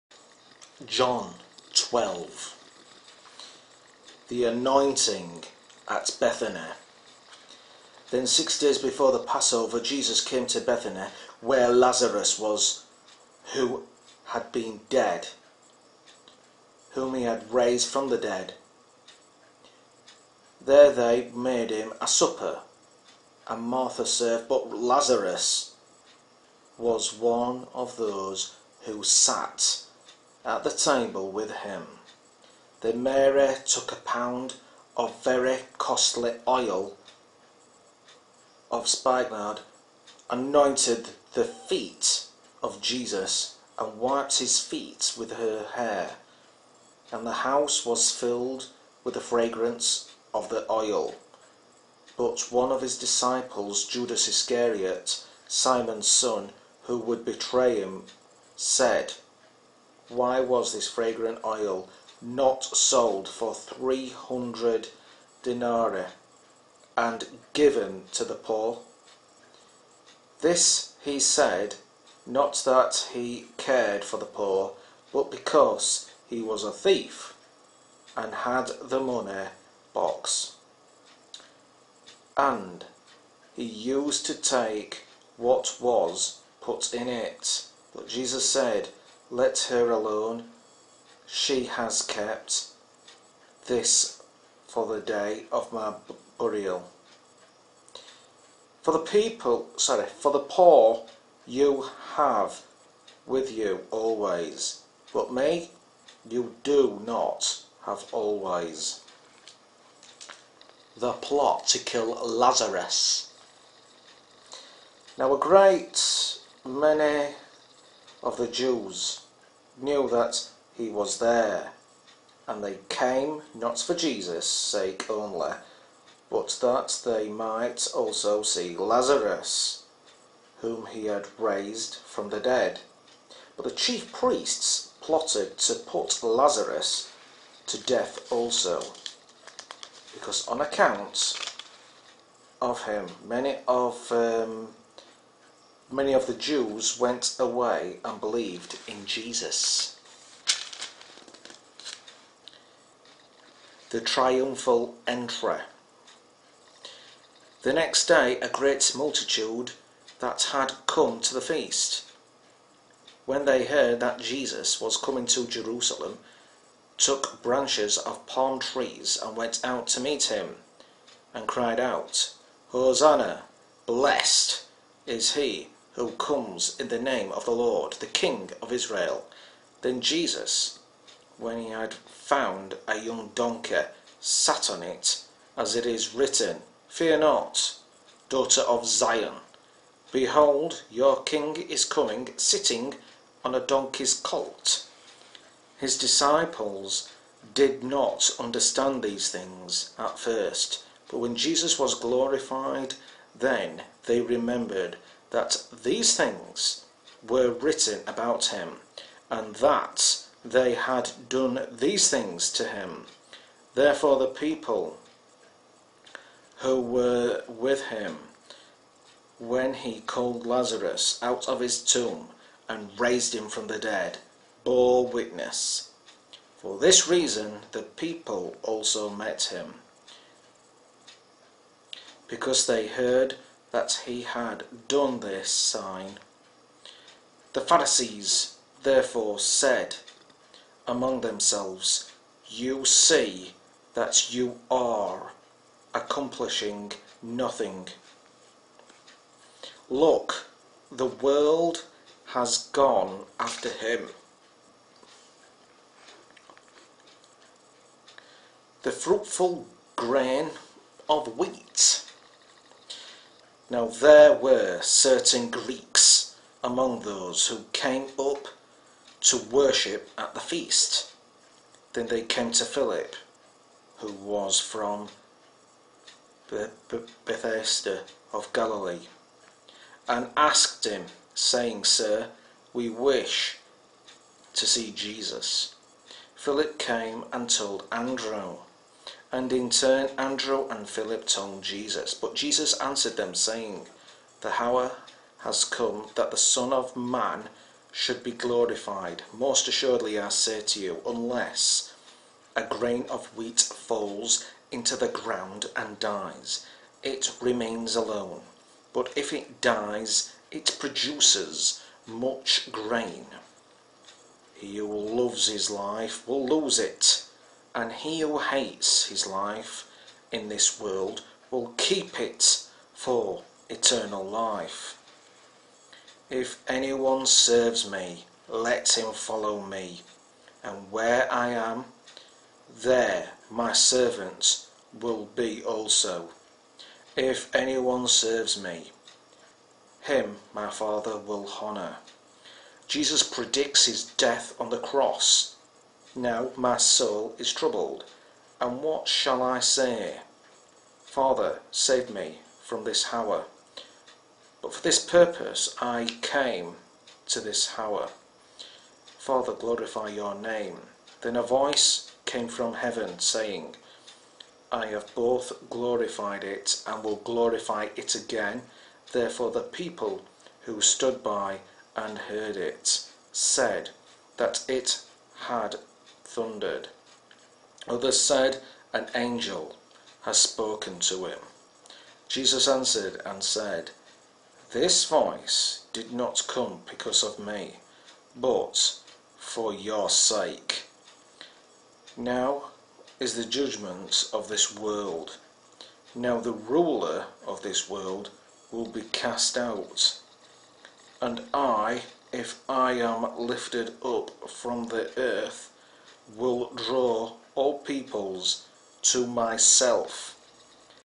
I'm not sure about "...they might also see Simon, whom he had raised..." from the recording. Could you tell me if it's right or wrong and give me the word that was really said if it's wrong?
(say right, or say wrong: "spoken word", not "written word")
wrong: "Lazarus", not "Simon".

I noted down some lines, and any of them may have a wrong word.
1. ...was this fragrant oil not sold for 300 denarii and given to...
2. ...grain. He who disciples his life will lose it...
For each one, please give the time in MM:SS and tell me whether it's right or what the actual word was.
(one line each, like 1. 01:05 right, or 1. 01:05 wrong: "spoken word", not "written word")
1. 01:00 right
2. 05:12 wrong: "loves", not "disciples".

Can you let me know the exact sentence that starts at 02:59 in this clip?
Then Jesus, when he had found a young donkey, sat on it, as it is written, Fear not, daughter of Zion.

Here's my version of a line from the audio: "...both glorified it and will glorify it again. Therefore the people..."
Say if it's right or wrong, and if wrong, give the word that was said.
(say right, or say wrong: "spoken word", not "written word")
right.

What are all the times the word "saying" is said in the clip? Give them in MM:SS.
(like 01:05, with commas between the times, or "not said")
04:41, 04:53, 06:03.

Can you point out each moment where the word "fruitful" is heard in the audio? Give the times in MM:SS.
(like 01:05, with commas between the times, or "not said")
04:18.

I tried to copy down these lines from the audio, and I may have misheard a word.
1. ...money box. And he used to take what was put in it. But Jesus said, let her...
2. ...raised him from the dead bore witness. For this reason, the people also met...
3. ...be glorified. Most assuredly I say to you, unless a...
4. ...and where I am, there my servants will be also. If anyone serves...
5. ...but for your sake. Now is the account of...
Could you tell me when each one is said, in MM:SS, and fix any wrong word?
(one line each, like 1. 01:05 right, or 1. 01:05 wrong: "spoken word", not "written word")
1. 01:18 right
2. 03:42 right
3. 04:58 right
4. 05:30 right
5. 06:28 wrong: "judgment", not "account".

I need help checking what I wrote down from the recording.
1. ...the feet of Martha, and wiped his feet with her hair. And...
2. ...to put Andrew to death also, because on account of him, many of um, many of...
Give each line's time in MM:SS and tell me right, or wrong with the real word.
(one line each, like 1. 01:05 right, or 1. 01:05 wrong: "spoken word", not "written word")
1. 00:41 wrong: "Jesus", not "Martha"
2. 02:15 wrong: "Lazarus", not "Andrew".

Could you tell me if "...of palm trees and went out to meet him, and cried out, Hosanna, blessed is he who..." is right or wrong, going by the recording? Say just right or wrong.
right.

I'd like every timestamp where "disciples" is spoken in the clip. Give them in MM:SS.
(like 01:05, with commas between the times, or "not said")
00:52, 03:15.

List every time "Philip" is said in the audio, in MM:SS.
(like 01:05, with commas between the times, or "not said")
04:32, 04:46, 04:50.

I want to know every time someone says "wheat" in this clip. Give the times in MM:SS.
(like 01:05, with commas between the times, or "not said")
04:21, 05:03.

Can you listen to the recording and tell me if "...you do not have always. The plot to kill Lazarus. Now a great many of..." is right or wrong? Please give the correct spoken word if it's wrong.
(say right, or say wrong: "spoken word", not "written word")
right.